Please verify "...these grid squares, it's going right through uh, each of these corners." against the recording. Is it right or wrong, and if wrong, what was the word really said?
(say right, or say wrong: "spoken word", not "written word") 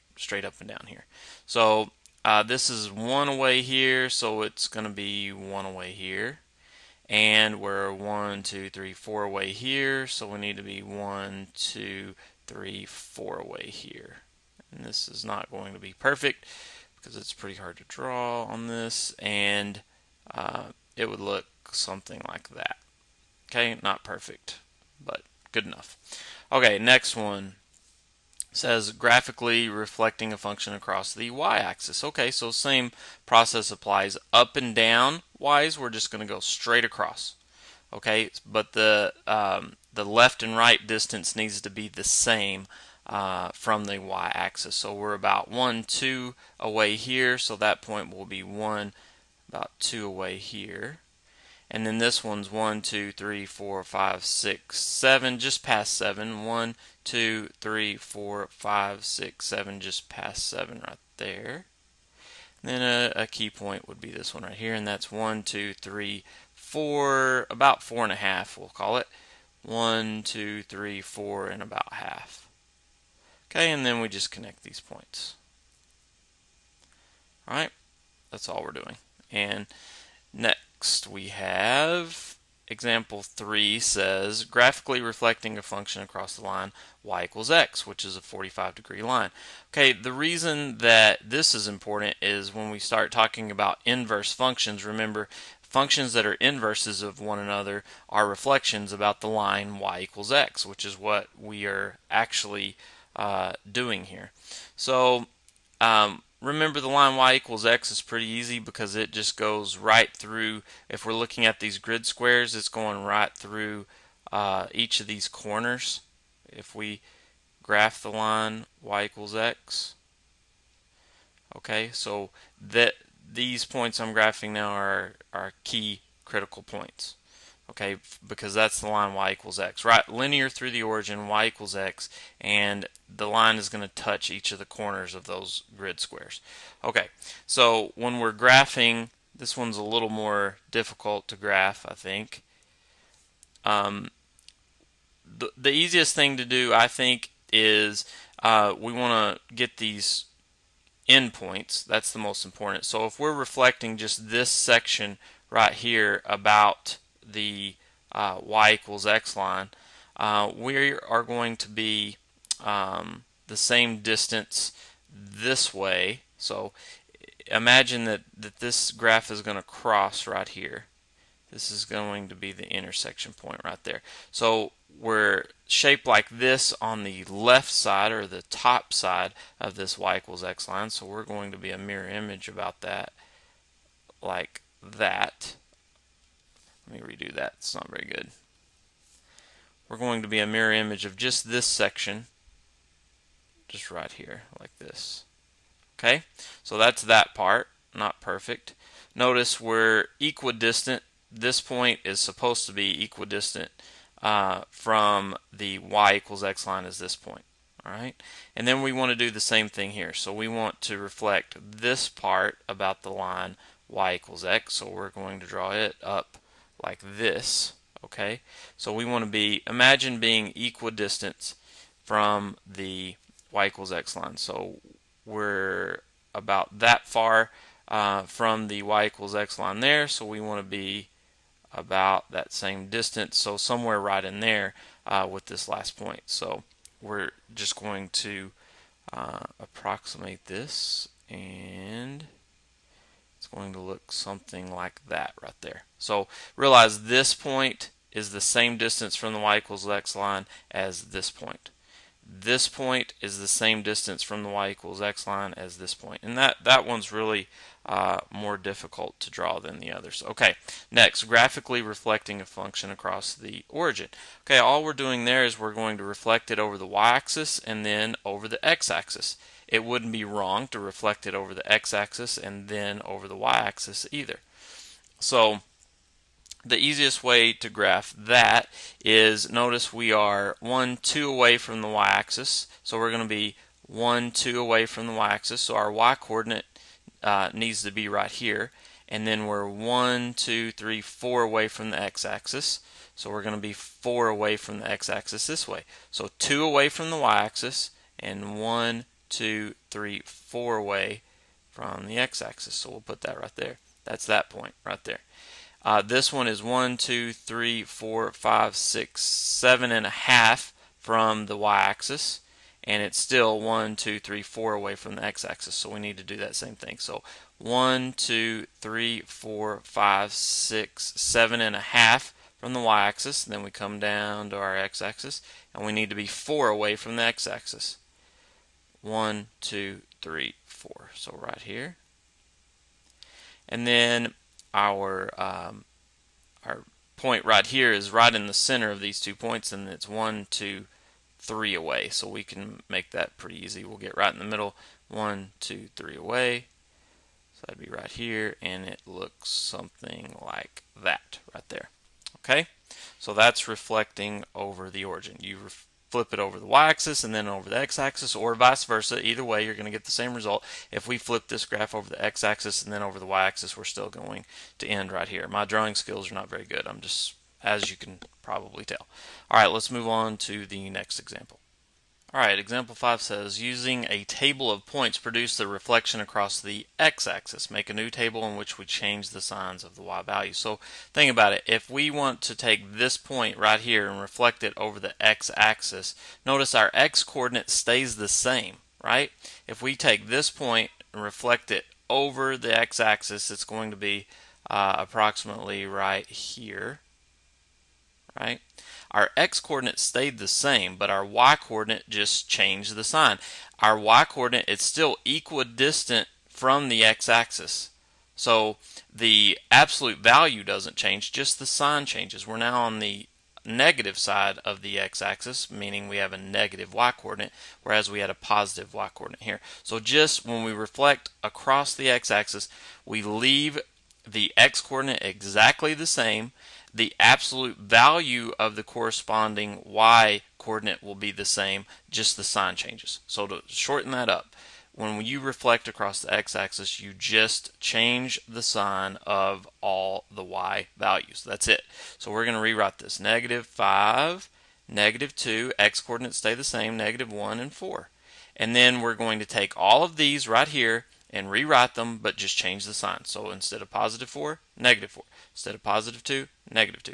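right.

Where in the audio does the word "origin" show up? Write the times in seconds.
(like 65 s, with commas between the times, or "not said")
130 s, 263 s, 355 s.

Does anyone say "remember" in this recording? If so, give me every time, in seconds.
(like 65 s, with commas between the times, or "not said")
94 s, 106 s.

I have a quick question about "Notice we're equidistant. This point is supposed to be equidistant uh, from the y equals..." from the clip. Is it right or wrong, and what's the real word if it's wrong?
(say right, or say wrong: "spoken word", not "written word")
right.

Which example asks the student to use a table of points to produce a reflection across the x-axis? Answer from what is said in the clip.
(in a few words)
Example 5.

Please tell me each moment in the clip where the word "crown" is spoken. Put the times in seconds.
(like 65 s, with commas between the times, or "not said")
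not said.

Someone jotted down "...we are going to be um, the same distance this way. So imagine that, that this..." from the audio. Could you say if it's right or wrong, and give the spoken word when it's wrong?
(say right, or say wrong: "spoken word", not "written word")
right.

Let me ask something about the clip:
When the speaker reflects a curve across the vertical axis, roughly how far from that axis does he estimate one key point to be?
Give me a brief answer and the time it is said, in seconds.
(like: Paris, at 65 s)
4 and a half, at 67 s.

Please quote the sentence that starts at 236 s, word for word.
So we're just going to uh, approximate this, and it's going to look something like that right there.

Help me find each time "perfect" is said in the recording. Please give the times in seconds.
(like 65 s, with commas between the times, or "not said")
15 s, 24 s, 198 s.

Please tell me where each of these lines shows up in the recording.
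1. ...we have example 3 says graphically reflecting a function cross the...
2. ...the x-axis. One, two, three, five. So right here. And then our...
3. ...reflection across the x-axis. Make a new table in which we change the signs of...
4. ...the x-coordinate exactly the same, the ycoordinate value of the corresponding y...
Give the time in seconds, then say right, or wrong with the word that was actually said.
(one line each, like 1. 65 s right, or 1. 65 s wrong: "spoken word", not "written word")
1. 81 s wrong: "across", not "cross"
2. 327 s wrong: "four", not "five"
3. 375 s right
4. 424 s wrong: "absolute", not "ycoordinate".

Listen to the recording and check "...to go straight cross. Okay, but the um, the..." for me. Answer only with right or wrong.
wrong.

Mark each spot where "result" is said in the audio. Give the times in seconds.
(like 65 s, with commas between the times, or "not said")
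360 s.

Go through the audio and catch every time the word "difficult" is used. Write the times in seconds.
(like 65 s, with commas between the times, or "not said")
140 s, 258 s.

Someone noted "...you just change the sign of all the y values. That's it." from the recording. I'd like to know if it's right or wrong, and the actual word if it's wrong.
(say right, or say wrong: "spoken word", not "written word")
right.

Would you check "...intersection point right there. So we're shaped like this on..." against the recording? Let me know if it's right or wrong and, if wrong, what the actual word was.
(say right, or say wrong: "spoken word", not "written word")
right.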